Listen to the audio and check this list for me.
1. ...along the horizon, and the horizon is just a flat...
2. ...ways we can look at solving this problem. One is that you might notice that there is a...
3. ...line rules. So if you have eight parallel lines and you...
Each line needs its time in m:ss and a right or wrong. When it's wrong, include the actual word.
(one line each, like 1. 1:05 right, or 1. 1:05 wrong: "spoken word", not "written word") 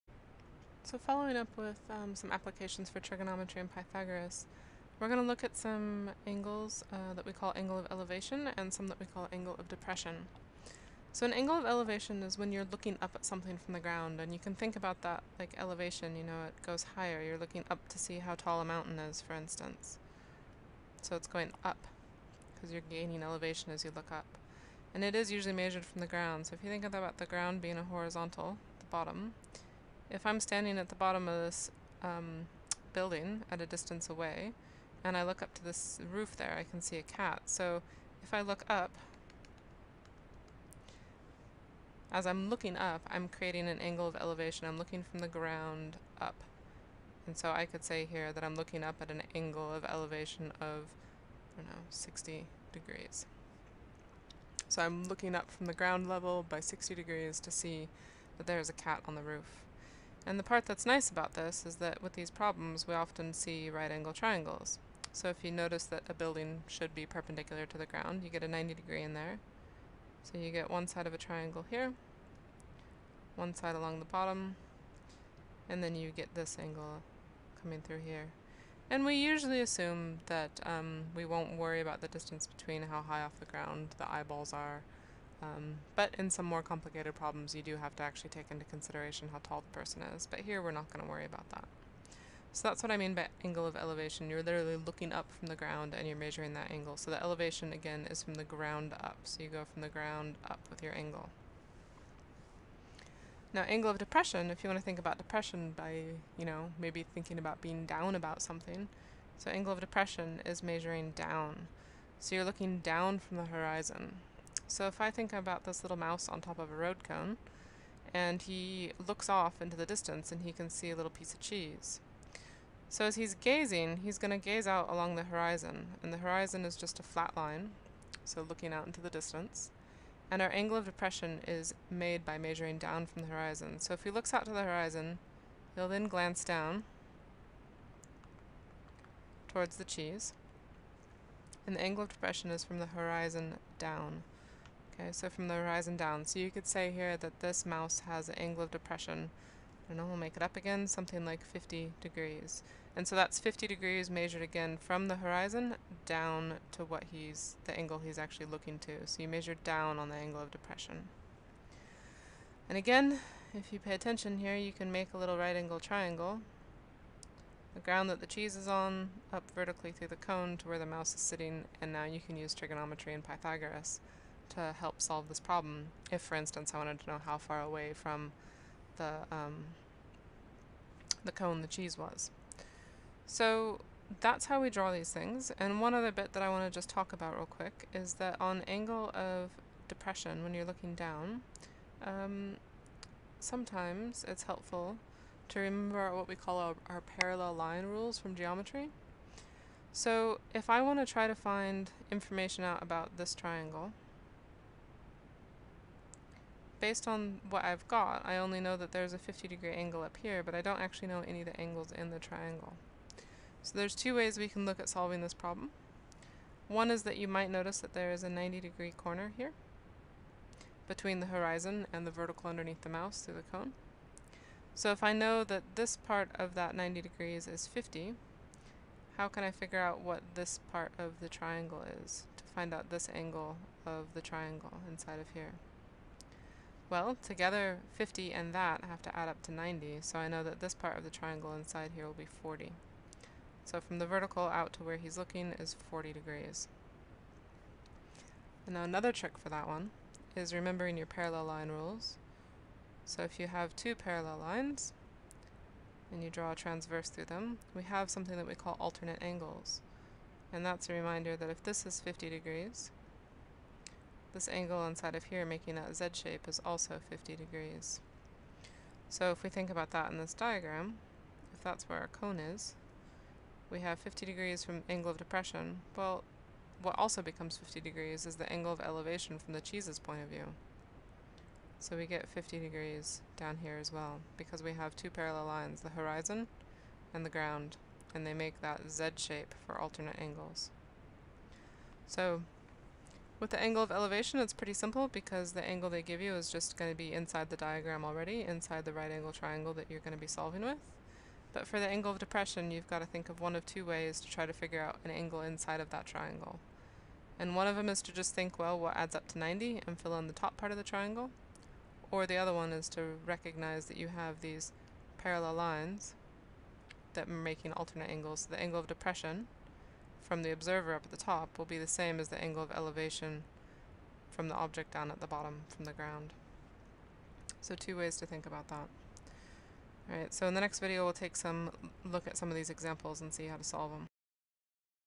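1. 2:04 right
2. 3:34 right
3. 4:11 wrong: "two", not "eight".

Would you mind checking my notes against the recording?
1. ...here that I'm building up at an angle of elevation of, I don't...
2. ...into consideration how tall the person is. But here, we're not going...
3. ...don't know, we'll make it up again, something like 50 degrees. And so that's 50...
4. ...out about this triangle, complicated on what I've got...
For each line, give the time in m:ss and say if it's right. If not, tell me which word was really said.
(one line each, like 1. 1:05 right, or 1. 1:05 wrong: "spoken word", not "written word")
1. 0:48 wrong: "looking", not "building"
2. 1:28 right
3. 2:29 right
4. 3:22 wrong: "based", not "complicated".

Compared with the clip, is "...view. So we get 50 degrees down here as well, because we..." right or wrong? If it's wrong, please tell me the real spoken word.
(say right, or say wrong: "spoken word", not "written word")
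right.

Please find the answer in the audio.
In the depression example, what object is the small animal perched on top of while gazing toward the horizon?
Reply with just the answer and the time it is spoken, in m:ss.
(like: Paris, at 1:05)
road cone, at 1:56.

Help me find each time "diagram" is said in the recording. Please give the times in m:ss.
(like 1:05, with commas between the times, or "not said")
4:30, 4:57.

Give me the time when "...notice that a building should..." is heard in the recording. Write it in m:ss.
1:05.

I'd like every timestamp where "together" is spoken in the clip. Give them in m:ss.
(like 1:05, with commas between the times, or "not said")
3:57.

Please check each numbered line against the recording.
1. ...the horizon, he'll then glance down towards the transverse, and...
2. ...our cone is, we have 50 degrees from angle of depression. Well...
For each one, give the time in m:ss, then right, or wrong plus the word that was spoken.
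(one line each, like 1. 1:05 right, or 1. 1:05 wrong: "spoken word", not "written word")
1. 2:14 wrong: "cheese", not "transverse"
2. 4:31 right.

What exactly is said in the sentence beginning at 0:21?
So it's going up, because you're gaining elevation as you look up.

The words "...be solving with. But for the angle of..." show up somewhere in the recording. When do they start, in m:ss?
5:00.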